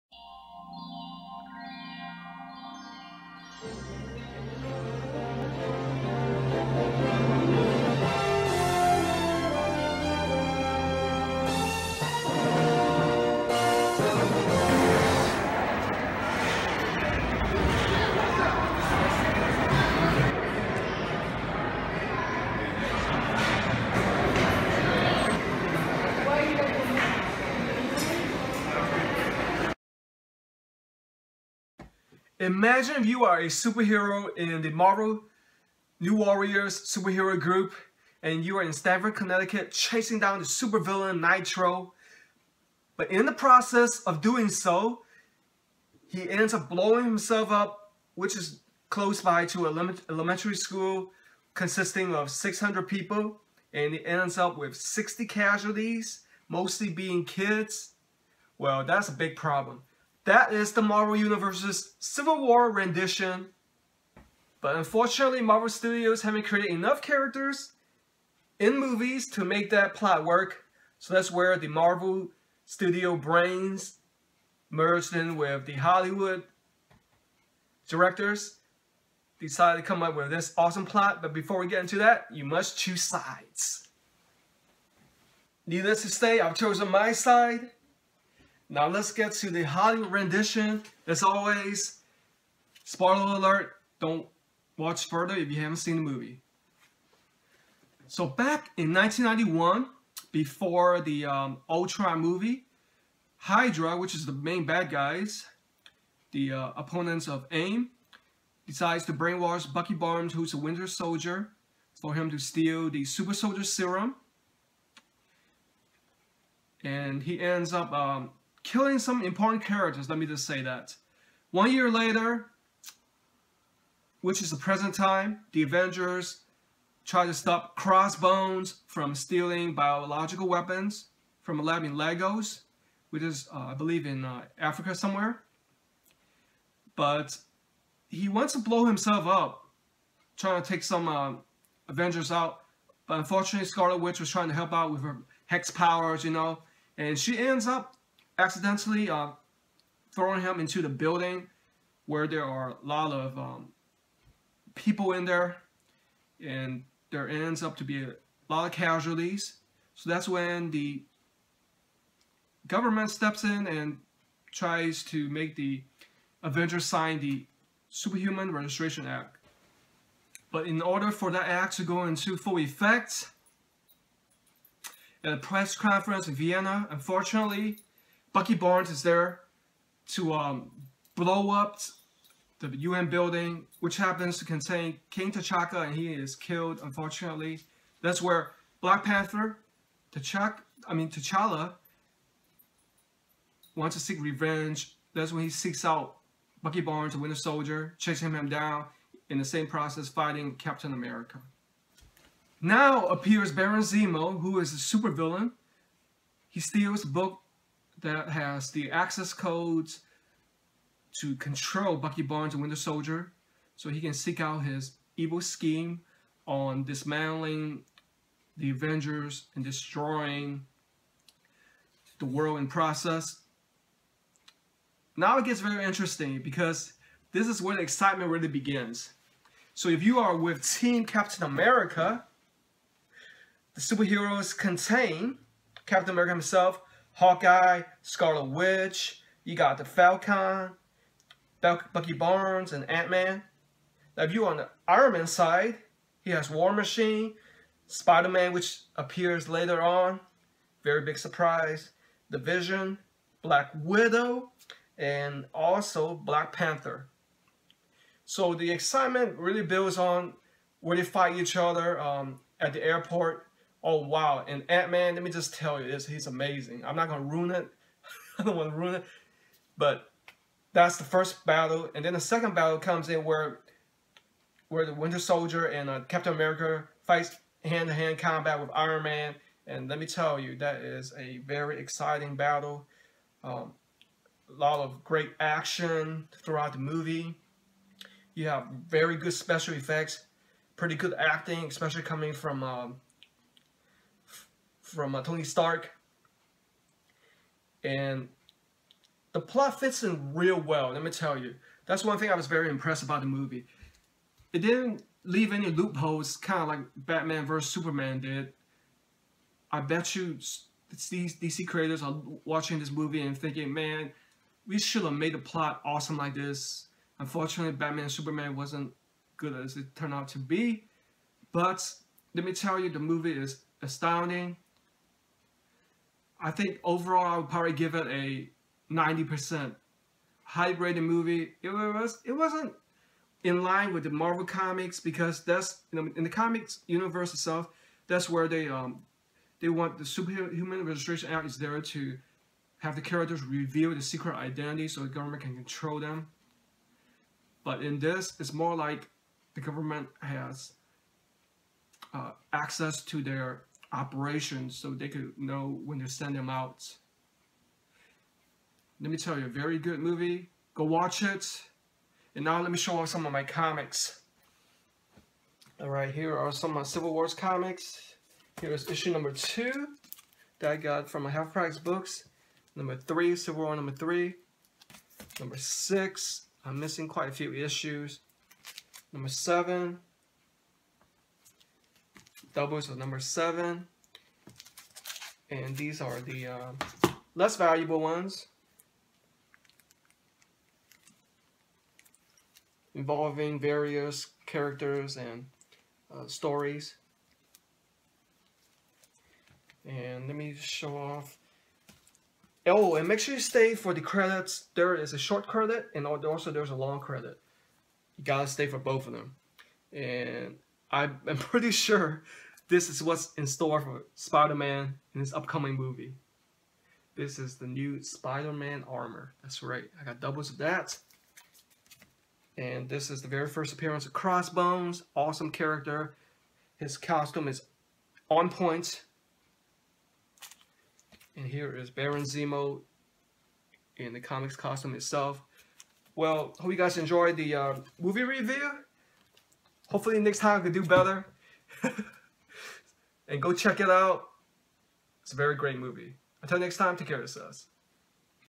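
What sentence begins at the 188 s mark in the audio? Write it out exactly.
That's where Black Panther, T'Chaka, I mean T'Challa, wants to seek revenge.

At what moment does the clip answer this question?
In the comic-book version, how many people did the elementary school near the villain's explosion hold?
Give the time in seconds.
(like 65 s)
52 s.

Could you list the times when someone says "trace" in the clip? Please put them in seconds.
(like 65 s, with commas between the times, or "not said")
not said.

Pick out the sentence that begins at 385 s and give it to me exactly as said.
And these are the uh, less valuable ones involving various characters and uh, stories.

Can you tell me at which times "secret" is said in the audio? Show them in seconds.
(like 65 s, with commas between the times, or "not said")
344 s.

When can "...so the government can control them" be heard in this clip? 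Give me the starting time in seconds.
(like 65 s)
344 s.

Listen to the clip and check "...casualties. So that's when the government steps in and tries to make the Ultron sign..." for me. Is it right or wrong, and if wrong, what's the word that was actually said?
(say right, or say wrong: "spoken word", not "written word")
wrong: "Avengers", not "Ultron".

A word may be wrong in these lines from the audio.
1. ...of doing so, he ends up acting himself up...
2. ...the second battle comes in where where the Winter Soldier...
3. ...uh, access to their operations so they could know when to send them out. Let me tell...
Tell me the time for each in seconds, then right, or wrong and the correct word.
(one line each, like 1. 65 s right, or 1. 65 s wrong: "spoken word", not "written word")
1. 44 s wrong: "blowing", not "acting"
2. 272 s right
3. 352 s right.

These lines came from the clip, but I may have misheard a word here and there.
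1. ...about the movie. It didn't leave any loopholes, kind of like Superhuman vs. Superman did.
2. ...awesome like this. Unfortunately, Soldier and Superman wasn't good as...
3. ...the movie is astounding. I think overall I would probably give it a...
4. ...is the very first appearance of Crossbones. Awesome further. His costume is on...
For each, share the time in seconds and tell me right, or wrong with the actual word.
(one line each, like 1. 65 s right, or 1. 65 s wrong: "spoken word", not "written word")
1. 303 s wrong: "Batman", not "Superhuman"
2. 315 s wrong: "Batman", not "Soldier"
3. 322 s right
4. 423 s wrong: "character", not "further".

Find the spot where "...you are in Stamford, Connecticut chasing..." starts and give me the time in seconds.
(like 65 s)
38 s.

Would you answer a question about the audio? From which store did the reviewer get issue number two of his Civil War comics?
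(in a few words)
Half Price Books.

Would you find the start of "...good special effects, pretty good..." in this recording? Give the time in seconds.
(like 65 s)
289 s.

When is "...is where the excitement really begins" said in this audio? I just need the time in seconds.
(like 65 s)
227 s.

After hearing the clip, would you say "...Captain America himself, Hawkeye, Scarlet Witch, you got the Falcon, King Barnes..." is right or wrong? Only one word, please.
wrong.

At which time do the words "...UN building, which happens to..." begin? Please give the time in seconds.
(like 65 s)
182 s.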